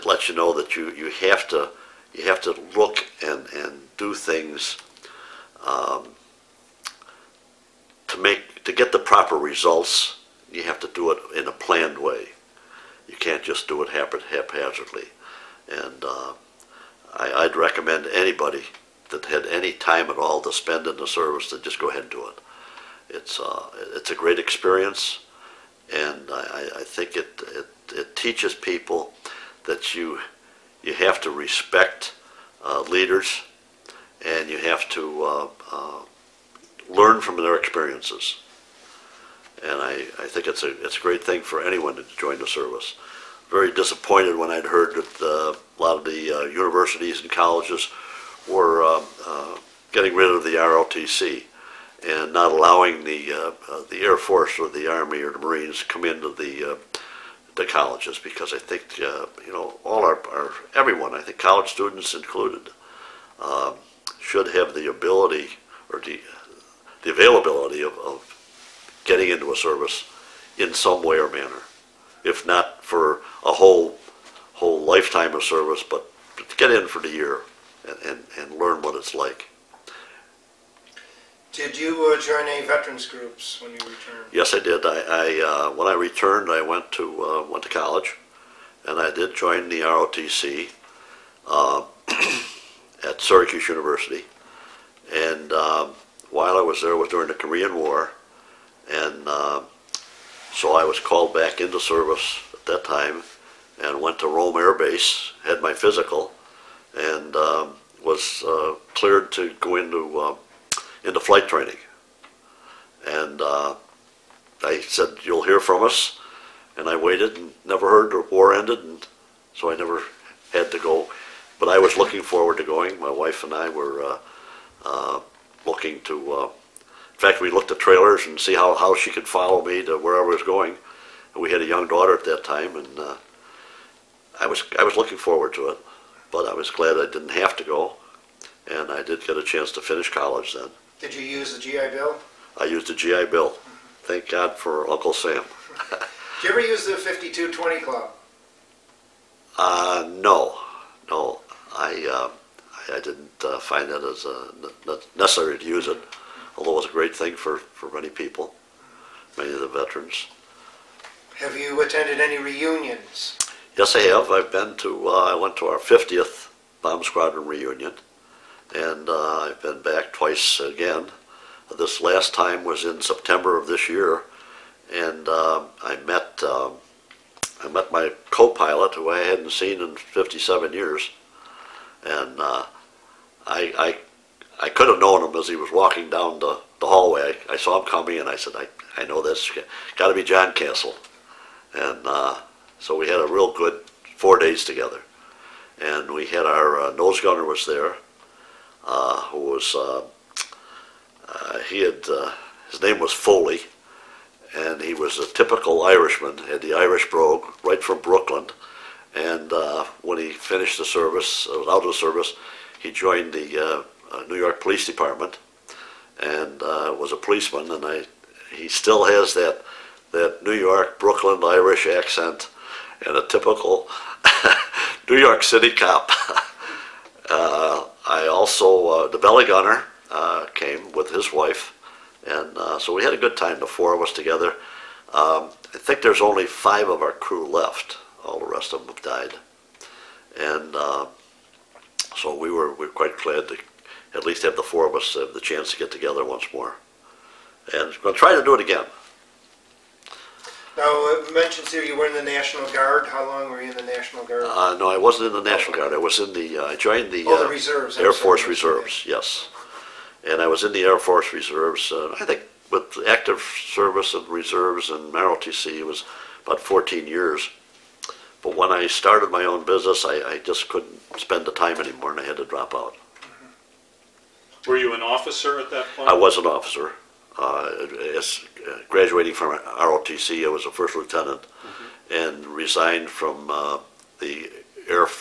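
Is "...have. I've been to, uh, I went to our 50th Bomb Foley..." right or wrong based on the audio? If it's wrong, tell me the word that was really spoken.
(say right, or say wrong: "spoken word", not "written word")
wrong: "Squadron", not "Foley".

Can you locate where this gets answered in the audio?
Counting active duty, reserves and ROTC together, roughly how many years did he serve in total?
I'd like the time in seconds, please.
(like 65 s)
266 s.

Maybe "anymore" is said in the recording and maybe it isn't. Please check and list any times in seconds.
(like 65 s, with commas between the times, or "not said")
271 s.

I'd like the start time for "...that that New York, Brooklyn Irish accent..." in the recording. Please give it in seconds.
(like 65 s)
219 s.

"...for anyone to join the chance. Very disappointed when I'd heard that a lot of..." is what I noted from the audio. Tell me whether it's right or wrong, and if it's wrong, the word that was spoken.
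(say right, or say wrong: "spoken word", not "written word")
wrong: "service", not "chance".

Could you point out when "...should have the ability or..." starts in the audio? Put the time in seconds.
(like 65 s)
64 s.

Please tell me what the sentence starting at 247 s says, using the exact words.
And we're going to try to do it again.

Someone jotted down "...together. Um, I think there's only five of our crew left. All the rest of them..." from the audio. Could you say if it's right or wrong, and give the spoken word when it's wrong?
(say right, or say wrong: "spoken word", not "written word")
right.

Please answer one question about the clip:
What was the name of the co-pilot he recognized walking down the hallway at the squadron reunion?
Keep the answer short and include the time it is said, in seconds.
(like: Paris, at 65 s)
John Castle, at 190 s.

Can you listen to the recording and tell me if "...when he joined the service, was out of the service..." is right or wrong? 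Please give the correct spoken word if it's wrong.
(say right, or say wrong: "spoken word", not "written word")
wrong: "finished", not "joined".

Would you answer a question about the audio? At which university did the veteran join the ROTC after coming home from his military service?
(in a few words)
Syracuse University.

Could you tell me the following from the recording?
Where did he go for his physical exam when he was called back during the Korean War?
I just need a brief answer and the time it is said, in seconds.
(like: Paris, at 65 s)
Rome Air Base, at 104 s.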